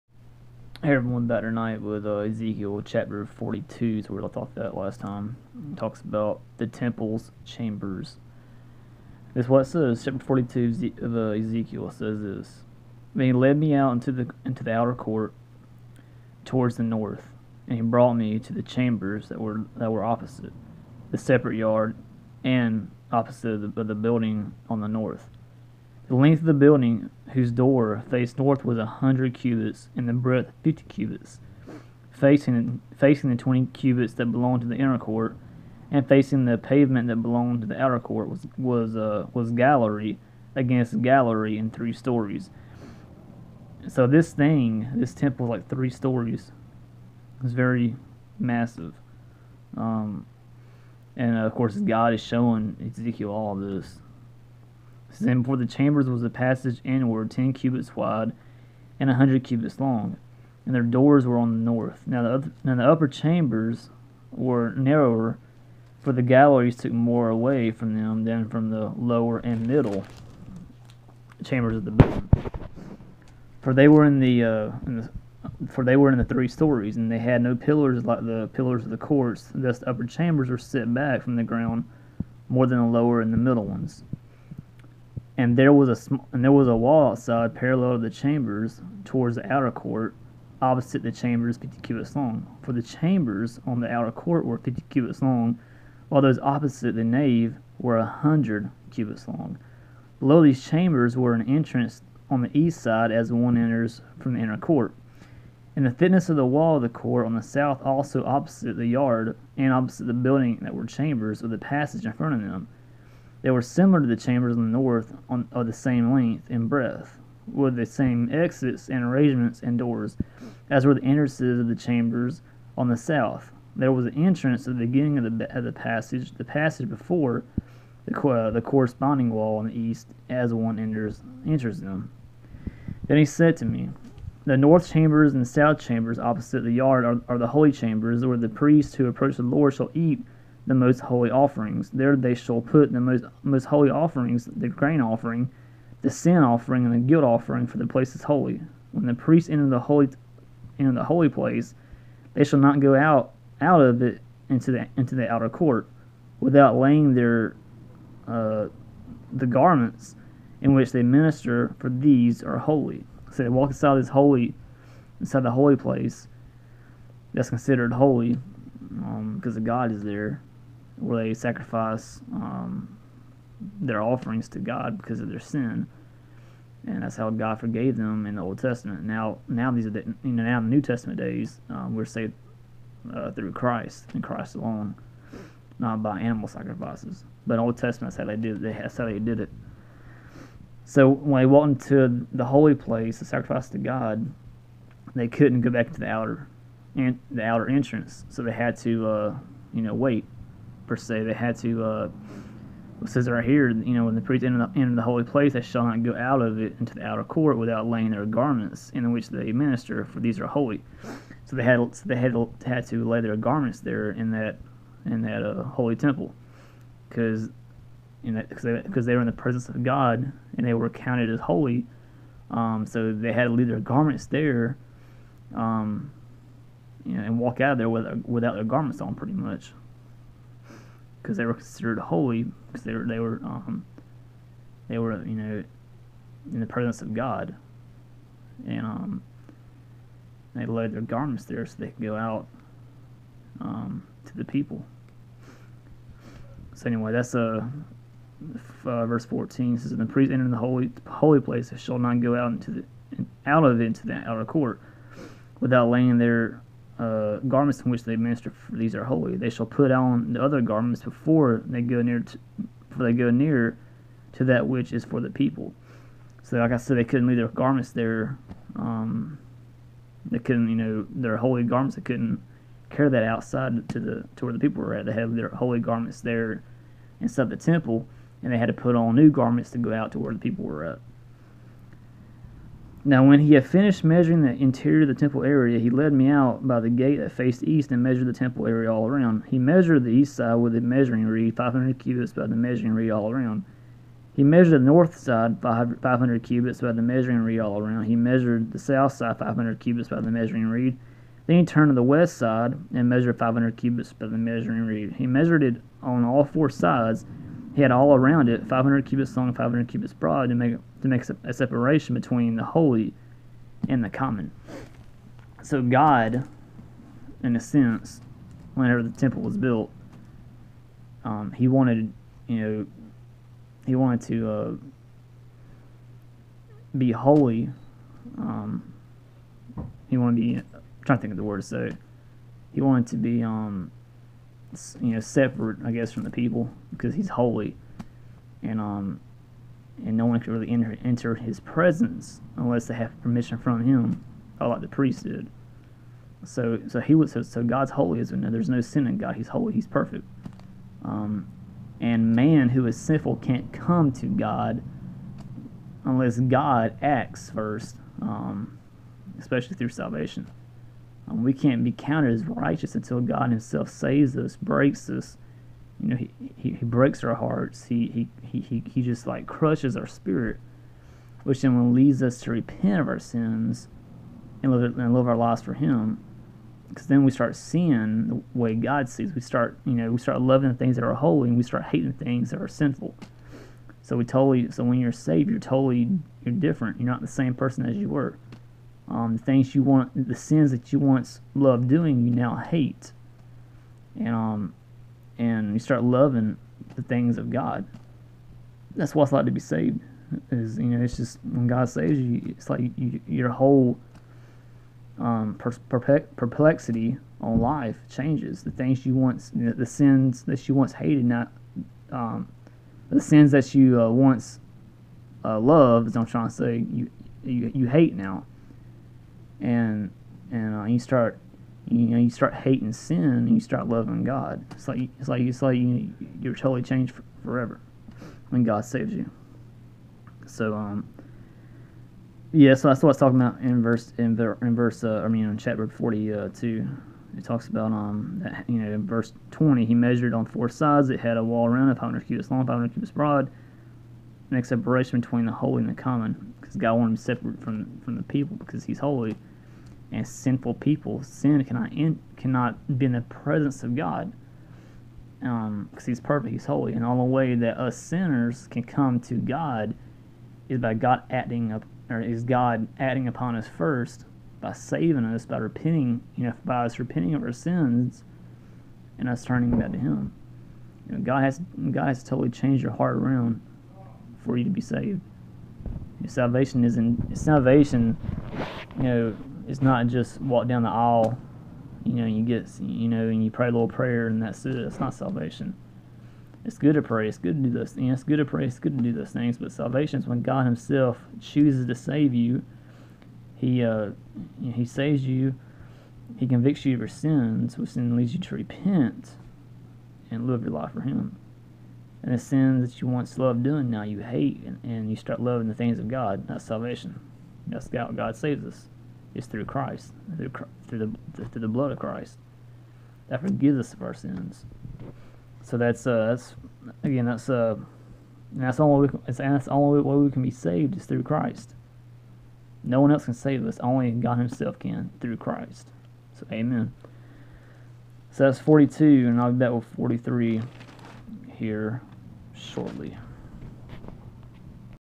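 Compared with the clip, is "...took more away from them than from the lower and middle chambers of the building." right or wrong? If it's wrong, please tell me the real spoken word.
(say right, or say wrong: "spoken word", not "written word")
right.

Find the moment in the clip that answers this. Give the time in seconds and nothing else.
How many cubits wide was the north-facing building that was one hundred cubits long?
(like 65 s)
30 s.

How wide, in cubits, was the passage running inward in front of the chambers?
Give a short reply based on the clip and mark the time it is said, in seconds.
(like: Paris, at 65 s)
10, at 57 s.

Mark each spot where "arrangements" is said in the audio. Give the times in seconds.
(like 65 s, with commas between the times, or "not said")
119 s.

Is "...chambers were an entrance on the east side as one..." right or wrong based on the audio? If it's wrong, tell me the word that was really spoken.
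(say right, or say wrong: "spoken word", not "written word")
right.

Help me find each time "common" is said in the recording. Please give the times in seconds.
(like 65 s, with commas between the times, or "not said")
314 s, 446 s.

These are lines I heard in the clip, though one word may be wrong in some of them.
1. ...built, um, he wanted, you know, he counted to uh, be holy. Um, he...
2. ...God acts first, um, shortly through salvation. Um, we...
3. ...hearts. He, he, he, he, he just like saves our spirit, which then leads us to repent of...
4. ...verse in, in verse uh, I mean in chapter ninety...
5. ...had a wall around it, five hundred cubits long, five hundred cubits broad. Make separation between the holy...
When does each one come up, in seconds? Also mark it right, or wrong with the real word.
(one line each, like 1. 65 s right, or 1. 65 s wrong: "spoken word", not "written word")
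1. 319 s wrong: "wanted", not "counted"
2. 356 s wrong: "especially", not "shortly"
3. 367 s wrong: "crushes", not "saves"
4. 433 s wrong: "forty", not "ninety"
5. 441 s right.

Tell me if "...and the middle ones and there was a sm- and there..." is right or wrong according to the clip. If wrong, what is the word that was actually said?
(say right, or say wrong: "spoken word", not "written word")
right.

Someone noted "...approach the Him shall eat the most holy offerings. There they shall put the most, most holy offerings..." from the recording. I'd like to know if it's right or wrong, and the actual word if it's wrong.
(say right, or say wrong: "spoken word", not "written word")
wrong: "Lord", not "Him".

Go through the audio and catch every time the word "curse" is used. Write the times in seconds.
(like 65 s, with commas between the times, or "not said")
not said.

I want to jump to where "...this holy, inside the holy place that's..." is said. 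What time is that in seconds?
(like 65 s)
163 s.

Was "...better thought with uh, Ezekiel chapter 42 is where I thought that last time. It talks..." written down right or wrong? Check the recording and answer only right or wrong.
wrong.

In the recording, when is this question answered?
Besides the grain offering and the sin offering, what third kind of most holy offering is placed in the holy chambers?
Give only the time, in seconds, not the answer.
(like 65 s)
146 s.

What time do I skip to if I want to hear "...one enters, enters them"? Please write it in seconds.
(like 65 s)
130 s.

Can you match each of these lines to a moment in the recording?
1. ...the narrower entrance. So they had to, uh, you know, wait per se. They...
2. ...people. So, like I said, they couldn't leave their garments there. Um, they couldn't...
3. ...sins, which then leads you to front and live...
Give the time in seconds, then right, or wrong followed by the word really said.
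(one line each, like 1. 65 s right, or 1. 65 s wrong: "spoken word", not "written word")
1. 197 s wrong: "outer", not "narrower"
2. 265 s right
3. 497 s wrong: "repent", not "front".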